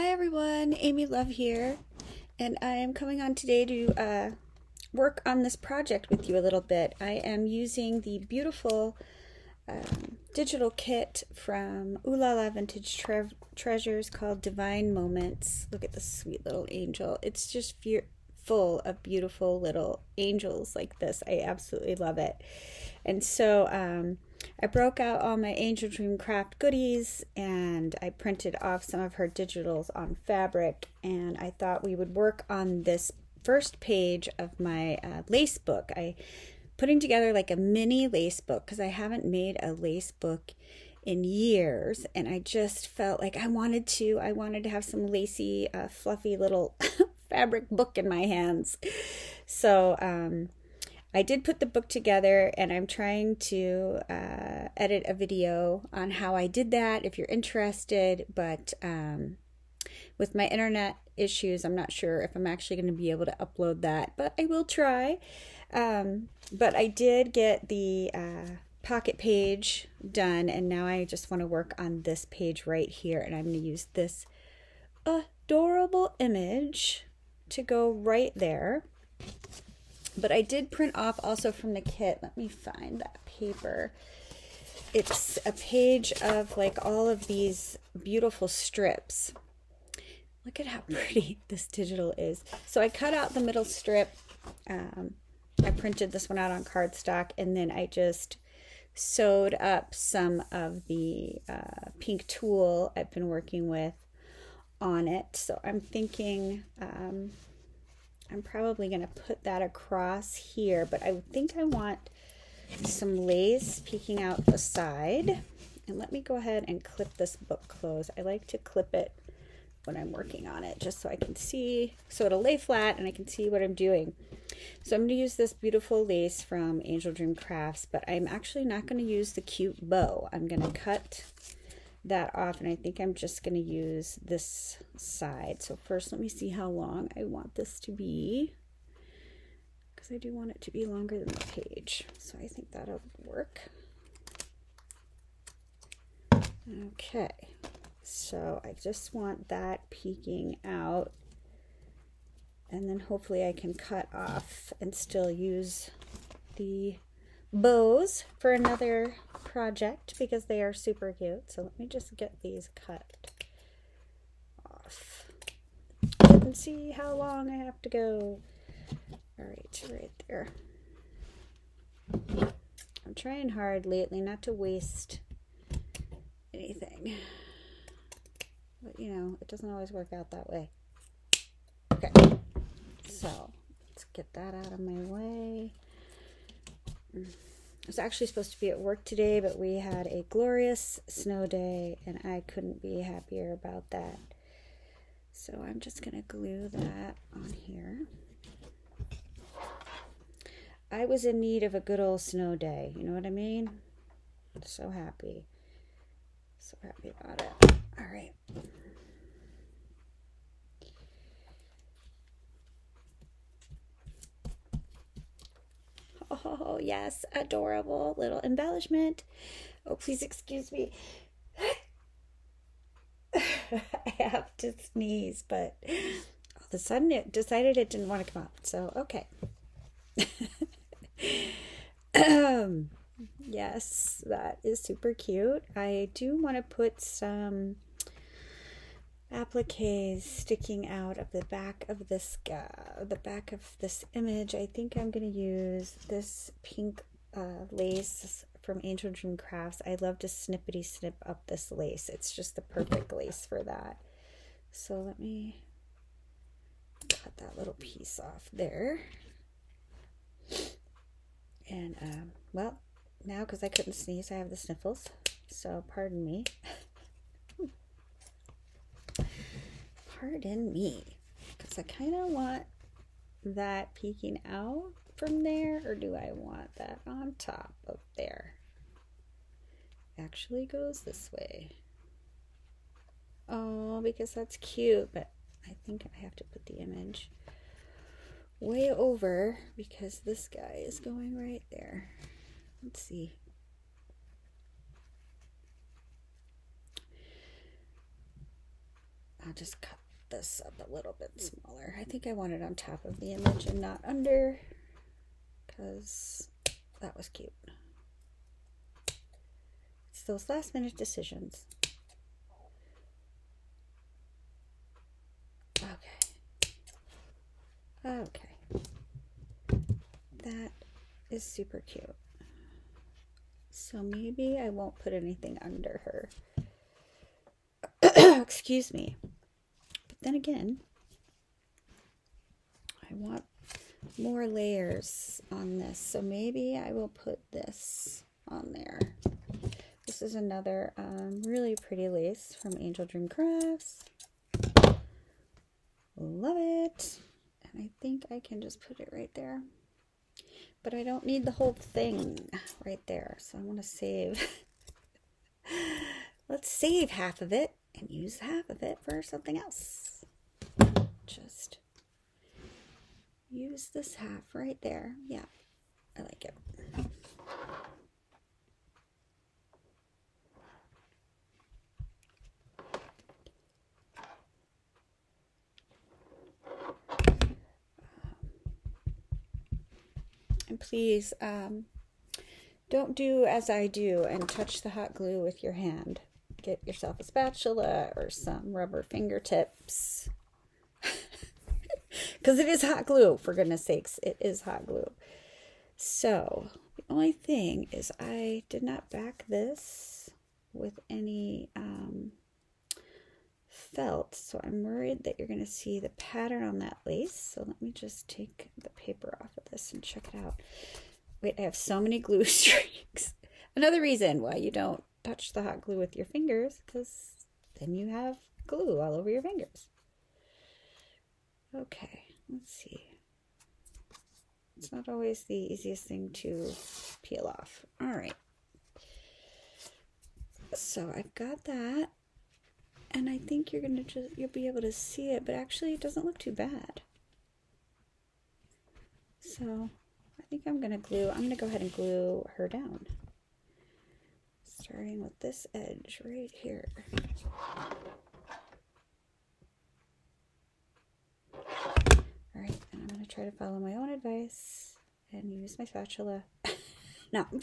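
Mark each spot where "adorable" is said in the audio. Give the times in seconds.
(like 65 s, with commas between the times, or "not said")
75 s, 217 s.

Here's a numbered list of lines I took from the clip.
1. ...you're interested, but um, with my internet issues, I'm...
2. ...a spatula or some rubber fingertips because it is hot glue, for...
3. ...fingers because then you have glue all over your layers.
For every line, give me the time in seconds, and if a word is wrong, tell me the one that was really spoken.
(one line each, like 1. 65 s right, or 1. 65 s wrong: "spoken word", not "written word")
1. 57 s right
2. 387 s right
3. 416 s wrong: "fingers", not "layers".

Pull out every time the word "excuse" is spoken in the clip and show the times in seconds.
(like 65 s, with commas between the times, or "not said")
220 s, 328 s.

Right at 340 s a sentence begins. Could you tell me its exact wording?
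This is another um, really pretty lace from Angel Dream Crafts.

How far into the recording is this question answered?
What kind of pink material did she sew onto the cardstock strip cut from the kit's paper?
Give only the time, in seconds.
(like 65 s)
102 s.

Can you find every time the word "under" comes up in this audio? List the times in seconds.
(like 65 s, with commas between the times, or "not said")
304 s, 325 s.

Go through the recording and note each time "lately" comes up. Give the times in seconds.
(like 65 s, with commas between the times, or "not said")
173 s.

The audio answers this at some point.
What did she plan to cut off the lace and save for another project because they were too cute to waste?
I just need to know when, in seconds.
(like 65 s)
156 s.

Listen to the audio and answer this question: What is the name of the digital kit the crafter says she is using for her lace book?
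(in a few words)
Divine Moments.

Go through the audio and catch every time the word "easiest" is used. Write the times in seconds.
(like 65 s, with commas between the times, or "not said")
425 s.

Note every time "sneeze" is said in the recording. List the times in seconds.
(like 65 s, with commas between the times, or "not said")
224 s, 263 s.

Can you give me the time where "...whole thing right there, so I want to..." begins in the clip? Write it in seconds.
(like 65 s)
351 s.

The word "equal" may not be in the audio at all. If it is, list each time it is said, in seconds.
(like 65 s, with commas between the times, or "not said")
not said.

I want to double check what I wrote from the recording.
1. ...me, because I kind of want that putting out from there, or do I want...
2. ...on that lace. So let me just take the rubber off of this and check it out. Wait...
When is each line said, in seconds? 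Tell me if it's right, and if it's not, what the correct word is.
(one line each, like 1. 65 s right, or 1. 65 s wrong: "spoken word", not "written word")
1. 270 s wrong: "peeking", not "putting"
2. 406 s wrong: "paper", not "rubber".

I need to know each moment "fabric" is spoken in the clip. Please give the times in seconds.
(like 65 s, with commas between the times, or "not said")
30 s, 47 s.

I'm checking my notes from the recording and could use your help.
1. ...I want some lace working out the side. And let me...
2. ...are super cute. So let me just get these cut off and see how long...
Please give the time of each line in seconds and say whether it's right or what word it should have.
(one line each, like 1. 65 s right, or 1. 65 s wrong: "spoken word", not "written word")
1. 111 s wrong: "peeking", not "working"
2. 160 s right.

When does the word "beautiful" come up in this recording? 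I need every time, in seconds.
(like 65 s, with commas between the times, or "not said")
8 s, 19 s, 88 s, 125 s.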